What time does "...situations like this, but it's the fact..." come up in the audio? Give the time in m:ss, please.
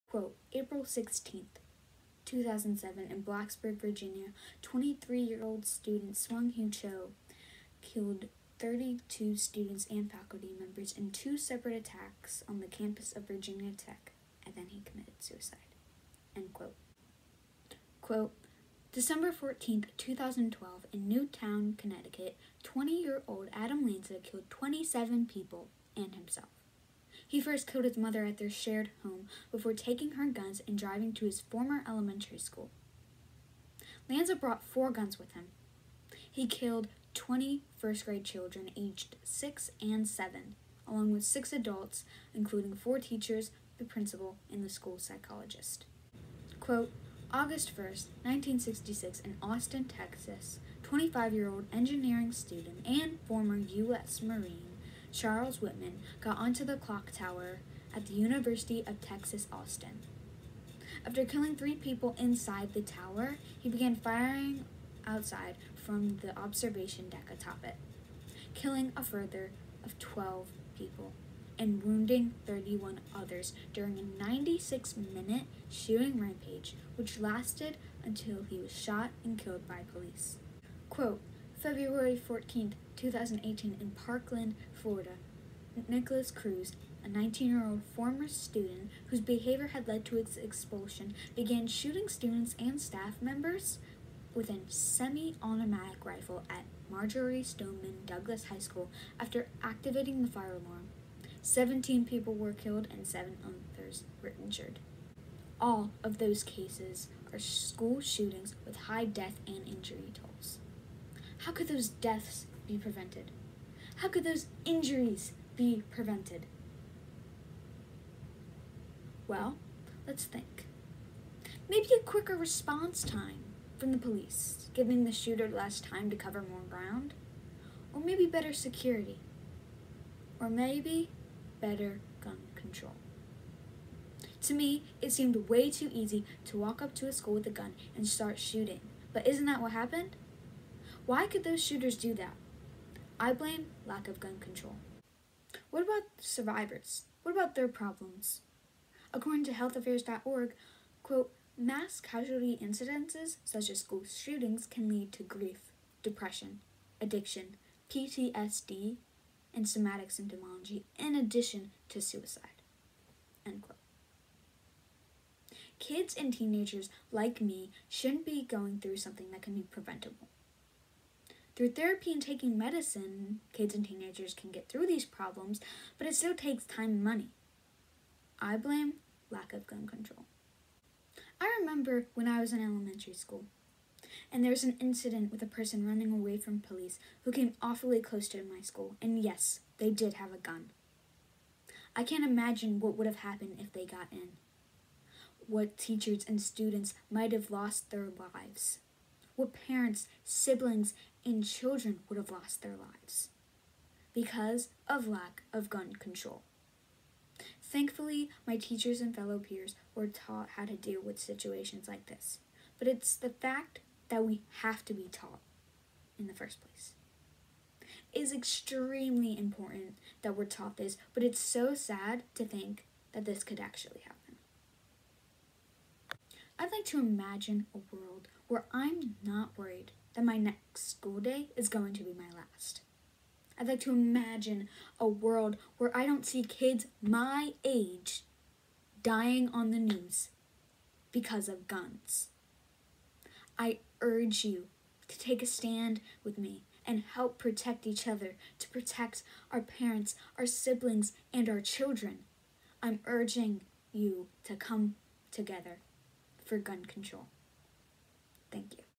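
3:31.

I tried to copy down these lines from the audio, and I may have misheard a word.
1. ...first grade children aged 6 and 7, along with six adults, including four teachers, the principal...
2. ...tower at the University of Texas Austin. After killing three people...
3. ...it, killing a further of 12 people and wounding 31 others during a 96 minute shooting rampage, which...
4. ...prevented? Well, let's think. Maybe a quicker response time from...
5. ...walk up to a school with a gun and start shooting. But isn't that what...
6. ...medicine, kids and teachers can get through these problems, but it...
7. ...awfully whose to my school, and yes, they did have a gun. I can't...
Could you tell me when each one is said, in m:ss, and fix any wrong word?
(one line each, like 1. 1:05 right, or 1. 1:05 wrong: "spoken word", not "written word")
1. 0:37 right
2. 0:57 right
3. 1:07 right
4. 1:55 right
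5. 2:16 right
6. 2:52 wrong: "teenagers", not "teachers"
7. 3:07 wrong: "close", not "whose".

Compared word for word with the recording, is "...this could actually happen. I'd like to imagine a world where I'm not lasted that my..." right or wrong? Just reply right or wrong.
wrong.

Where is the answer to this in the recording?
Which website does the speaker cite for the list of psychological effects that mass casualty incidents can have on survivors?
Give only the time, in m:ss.
2:29.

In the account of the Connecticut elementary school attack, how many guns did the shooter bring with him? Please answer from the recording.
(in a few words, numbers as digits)
4.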